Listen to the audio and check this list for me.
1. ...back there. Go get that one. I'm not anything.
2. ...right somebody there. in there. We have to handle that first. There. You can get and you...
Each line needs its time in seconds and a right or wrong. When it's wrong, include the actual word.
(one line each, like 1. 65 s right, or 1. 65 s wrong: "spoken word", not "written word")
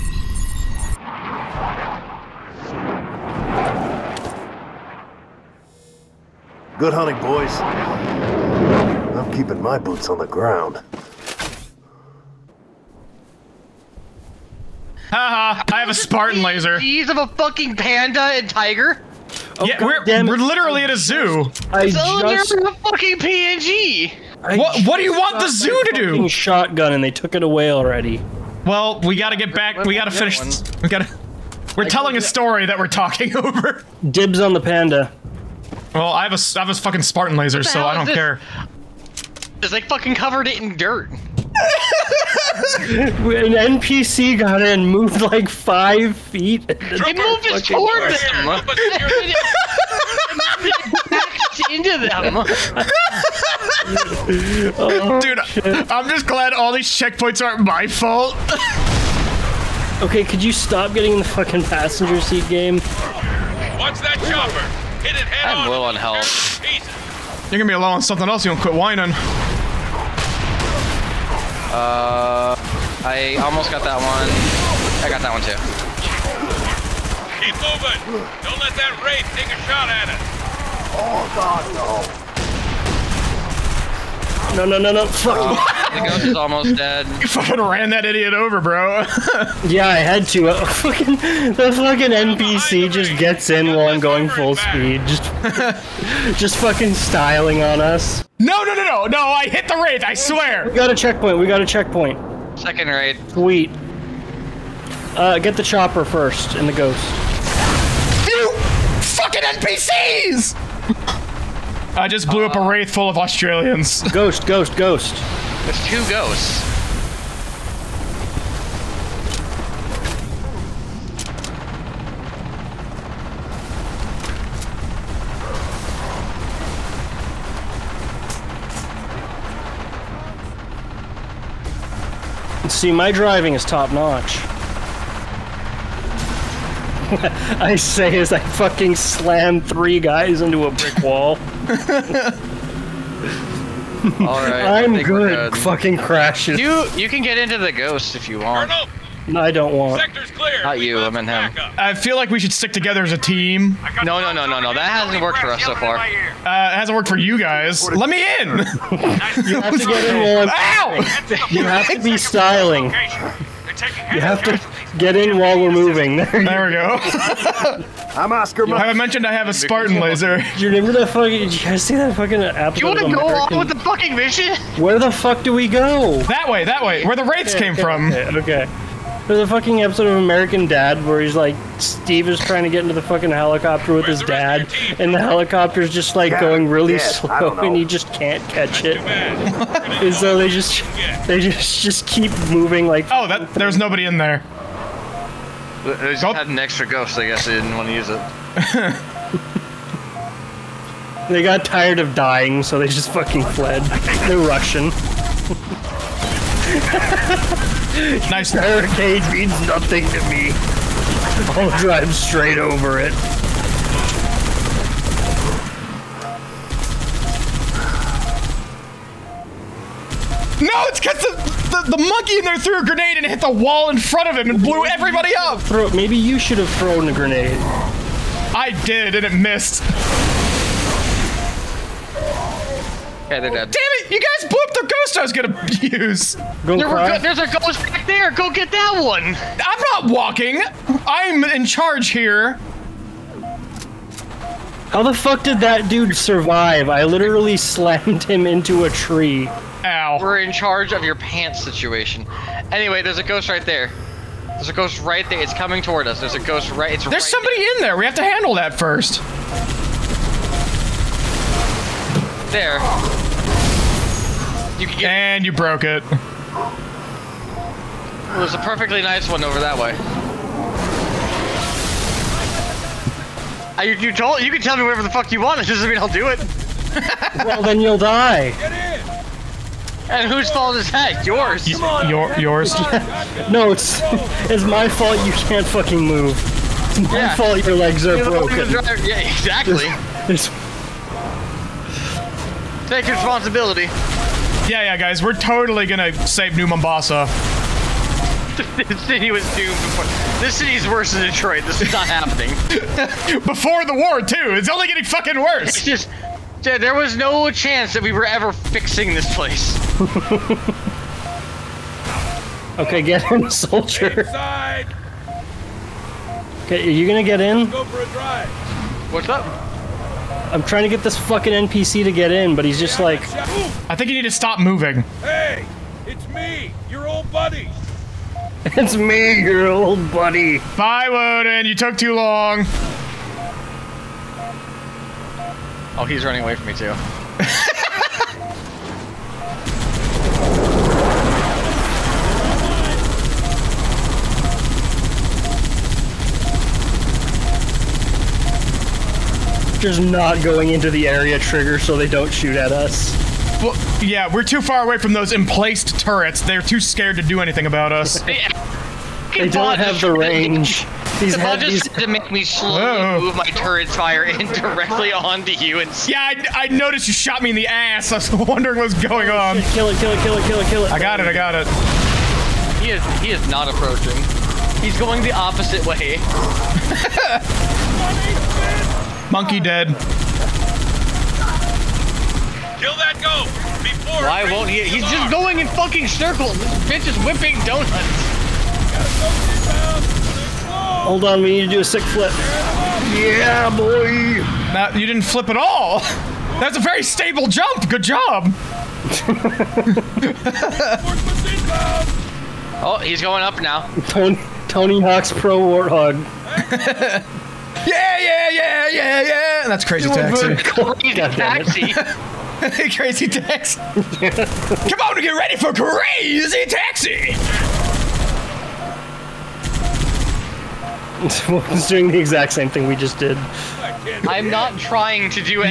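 1. 237 s wrong: "walking", not "anything"
2. 257 s right.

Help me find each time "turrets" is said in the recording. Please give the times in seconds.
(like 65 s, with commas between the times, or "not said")
355 s, 363 s.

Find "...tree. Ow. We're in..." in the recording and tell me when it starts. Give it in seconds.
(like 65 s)
248 s.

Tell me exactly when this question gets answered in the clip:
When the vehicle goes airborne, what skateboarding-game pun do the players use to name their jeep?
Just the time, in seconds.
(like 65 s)
404 s.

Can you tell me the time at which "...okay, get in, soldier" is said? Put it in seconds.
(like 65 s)
312 s.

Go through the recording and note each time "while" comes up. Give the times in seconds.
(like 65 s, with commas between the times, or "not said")
93 s, 165 s.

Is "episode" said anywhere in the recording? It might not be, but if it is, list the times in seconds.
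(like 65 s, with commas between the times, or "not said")
172 s, 179 s.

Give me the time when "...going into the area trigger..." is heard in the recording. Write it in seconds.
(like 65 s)
350 s.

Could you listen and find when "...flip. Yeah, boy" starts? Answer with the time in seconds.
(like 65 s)
392 s.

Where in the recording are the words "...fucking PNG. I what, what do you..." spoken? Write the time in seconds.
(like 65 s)
22 s.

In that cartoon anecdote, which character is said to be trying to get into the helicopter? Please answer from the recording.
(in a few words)
Steve.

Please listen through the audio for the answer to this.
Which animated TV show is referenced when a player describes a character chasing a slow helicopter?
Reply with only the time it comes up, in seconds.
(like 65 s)
180 s.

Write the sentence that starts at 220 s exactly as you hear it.
No, it's because the, monkey in there threw a grenade and hit the wall in front of him and blew everybody up.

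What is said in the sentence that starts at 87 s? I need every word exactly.
You fucking ran that idiot over, bro.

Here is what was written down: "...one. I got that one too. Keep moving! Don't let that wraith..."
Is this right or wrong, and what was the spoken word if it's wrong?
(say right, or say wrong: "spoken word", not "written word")
right.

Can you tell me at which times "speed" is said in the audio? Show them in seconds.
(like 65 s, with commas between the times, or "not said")
94 s.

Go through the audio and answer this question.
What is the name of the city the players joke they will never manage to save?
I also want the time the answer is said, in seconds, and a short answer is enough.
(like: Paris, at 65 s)
New Mombasa, at 296 s.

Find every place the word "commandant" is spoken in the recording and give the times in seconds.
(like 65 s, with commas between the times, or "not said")
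not said.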